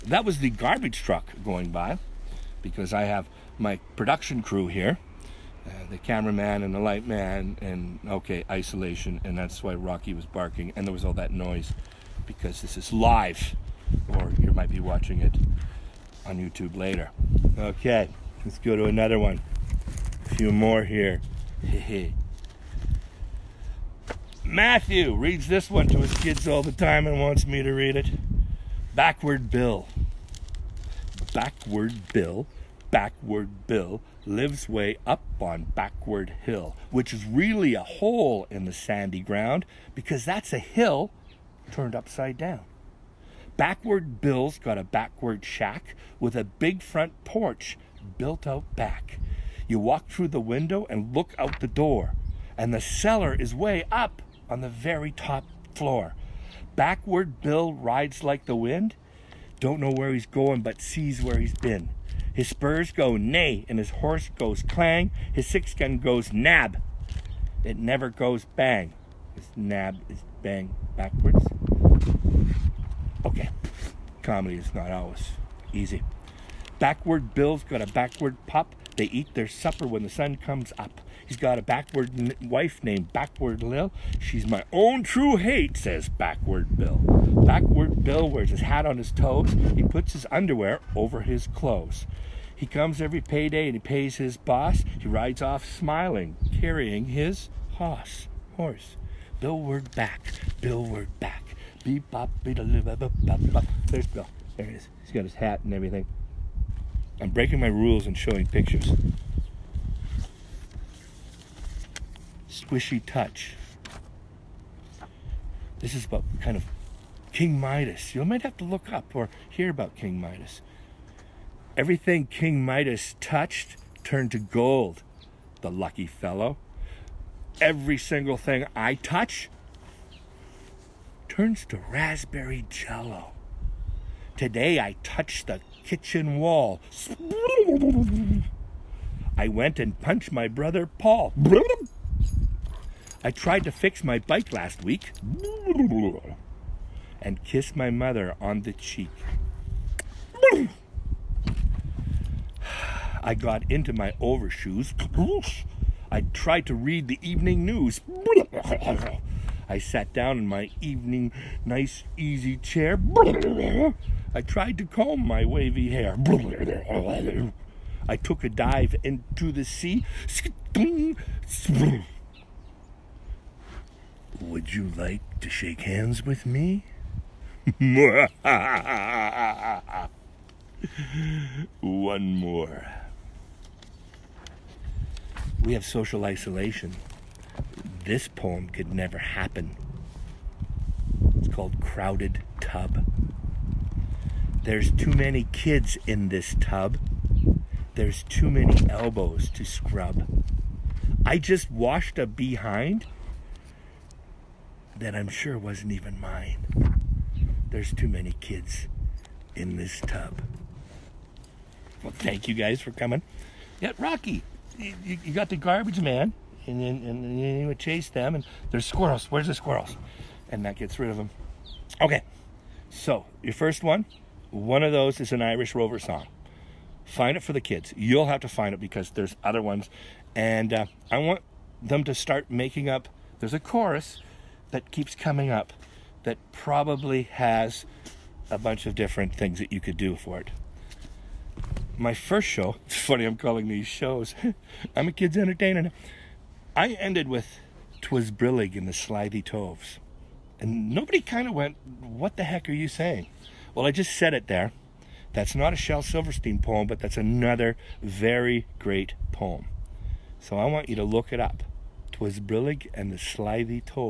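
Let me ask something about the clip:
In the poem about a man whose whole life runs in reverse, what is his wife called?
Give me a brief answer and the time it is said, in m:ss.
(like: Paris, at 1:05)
Backward Lil, at 1:23.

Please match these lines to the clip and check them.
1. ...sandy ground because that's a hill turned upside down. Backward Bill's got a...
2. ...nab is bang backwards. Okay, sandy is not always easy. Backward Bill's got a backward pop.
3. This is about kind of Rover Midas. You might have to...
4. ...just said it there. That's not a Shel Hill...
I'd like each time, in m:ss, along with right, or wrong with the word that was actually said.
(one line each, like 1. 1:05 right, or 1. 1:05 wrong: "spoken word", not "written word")
1. 0:38 right
2. 1:09 wrong: "comedy", not "sandy"
3. 1:55 wrong: "King", not "Rover"
4. 4:13 wrong: "Silverstein", not "Hill".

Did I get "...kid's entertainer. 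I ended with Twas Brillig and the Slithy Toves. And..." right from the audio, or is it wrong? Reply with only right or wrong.
right.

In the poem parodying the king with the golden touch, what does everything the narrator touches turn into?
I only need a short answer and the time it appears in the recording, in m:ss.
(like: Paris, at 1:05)
raspberry jello, at 2:11.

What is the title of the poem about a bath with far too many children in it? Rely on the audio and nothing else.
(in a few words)
Crowded Tub.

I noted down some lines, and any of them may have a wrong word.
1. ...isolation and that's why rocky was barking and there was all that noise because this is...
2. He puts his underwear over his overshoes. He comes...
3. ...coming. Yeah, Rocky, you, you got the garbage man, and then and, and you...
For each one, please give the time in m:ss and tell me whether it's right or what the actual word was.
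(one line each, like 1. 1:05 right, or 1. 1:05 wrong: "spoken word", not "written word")
1. 0:08 right
2. 1:29 wrong: "clothes", not "overshoes"
3. 3:32 right.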